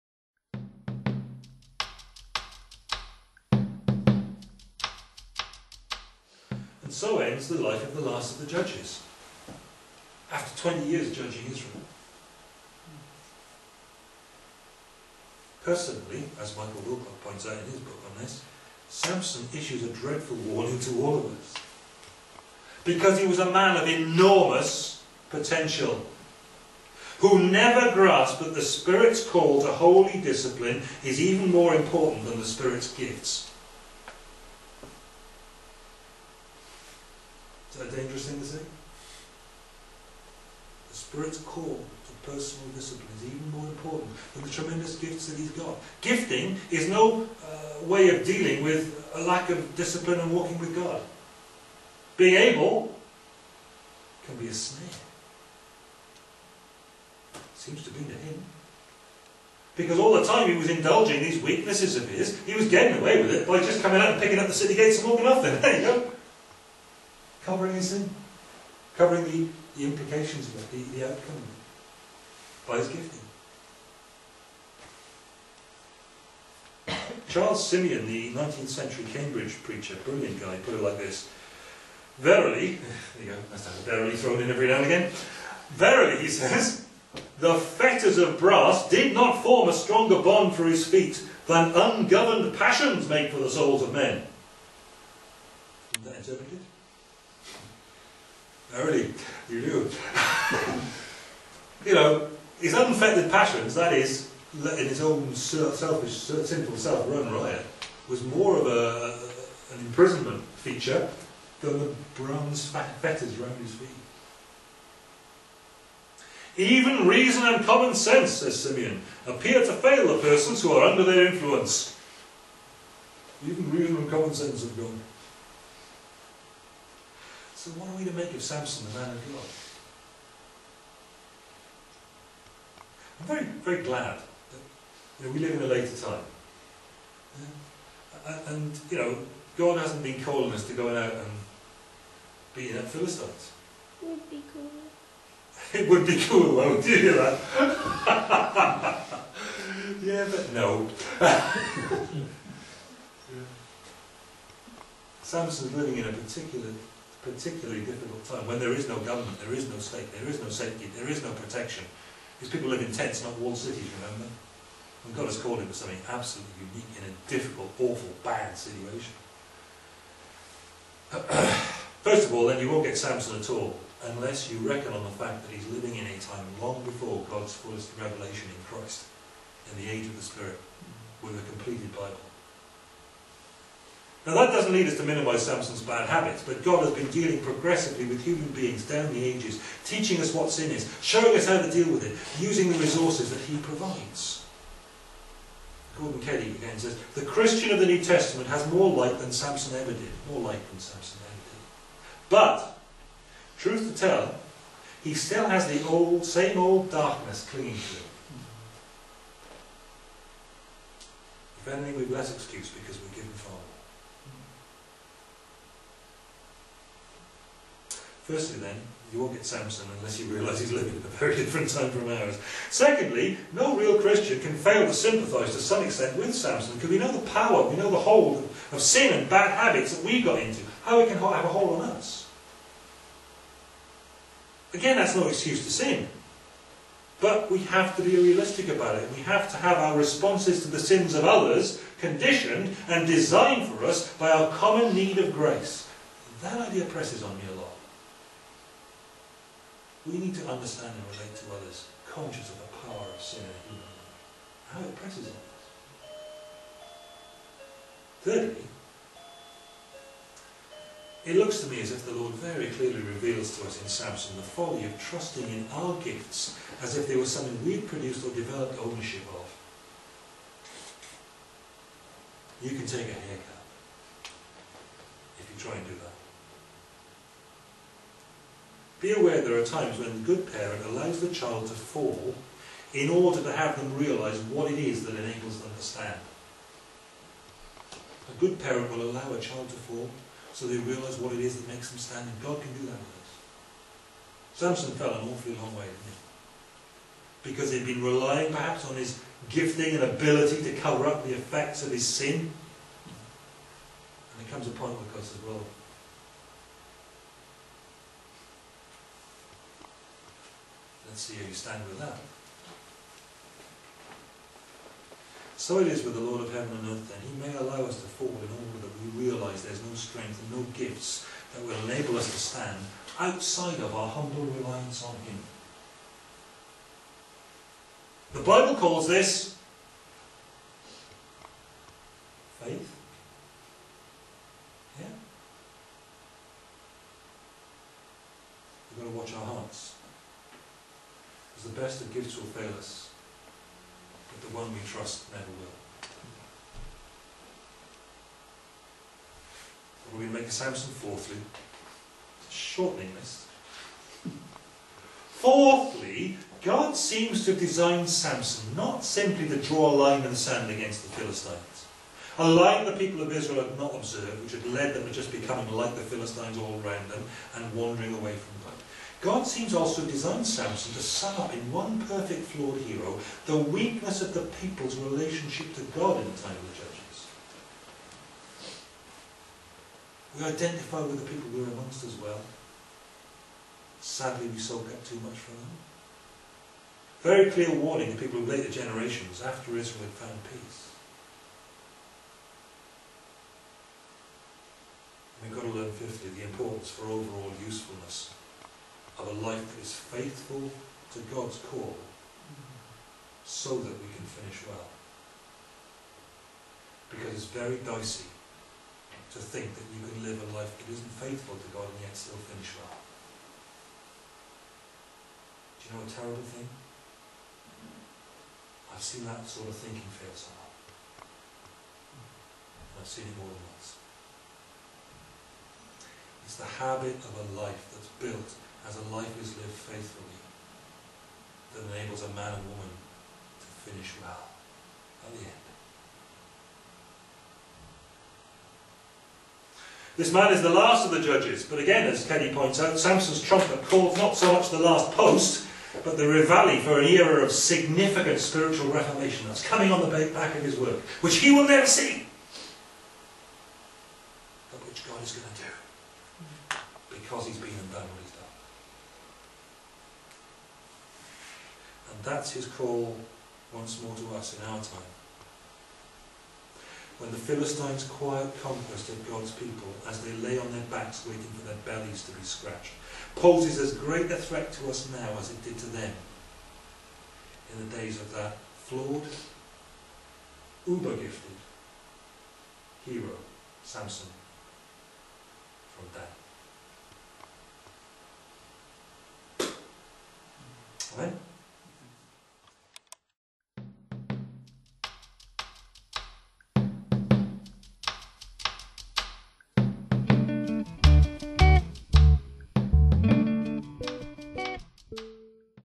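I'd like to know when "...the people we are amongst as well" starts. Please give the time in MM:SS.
06:21.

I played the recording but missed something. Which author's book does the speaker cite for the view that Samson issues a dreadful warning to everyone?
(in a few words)
Michael Wilcock.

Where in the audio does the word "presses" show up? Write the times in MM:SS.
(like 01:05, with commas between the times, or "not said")
04:06, 04:14.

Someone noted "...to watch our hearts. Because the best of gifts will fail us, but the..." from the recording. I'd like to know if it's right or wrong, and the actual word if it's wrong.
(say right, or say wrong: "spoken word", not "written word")
right.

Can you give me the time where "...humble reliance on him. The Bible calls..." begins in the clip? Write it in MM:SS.
05:24.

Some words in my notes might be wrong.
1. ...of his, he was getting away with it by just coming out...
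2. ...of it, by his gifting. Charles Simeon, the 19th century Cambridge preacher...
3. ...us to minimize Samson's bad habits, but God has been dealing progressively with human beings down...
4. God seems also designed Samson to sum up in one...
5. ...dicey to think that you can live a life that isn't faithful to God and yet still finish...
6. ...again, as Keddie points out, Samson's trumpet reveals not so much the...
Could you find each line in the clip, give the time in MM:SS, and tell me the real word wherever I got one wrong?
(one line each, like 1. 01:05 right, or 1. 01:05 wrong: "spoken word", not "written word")
1. 01:01 right
2. 01:11 right
3. 03:04 right
4. 06:09 right
5. 06:47 right
6. 07:21 wrong: "calls", not "reveals".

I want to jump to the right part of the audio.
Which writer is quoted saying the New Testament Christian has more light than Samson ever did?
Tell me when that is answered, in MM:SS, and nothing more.
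03:15.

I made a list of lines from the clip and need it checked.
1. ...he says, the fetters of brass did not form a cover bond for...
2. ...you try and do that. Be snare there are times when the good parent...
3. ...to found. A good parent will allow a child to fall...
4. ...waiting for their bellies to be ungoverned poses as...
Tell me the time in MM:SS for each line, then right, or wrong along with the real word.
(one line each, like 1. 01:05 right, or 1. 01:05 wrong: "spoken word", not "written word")
1. 01:26 wrong: "stronger", not "cover"
2. 04:35 wrong: "aware", not "snare"
3. 04:45 wrong: "stand", not "found"
4. 07:51 wrong: "scratched", not "ungoverned".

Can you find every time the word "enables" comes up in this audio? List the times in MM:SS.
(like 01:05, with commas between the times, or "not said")
04:45, 05:21, 07:11.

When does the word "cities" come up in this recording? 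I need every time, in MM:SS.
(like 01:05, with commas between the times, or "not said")
02:43.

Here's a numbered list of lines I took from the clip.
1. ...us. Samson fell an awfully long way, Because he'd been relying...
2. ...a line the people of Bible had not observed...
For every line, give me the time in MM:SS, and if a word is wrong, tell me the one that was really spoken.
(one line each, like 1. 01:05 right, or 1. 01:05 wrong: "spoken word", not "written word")
1. 04:53 right
2. 06:02 wrong: "Israel", not "Bible".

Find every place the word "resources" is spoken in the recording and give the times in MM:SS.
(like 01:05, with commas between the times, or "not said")
03:12.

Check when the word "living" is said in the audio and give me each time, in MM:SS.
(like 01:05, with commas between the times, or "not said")
02:35, 02:55, 03:40.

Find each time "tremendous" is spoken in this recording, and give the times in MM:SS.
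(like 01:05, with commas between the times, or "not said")
00:44.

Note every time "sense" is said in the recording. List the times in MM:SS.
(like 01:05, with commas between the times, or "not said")
01:57, 02:04.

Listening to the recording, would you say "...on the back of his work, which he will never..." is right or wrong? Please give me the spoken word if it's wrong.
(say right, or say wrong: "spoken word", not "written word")
right.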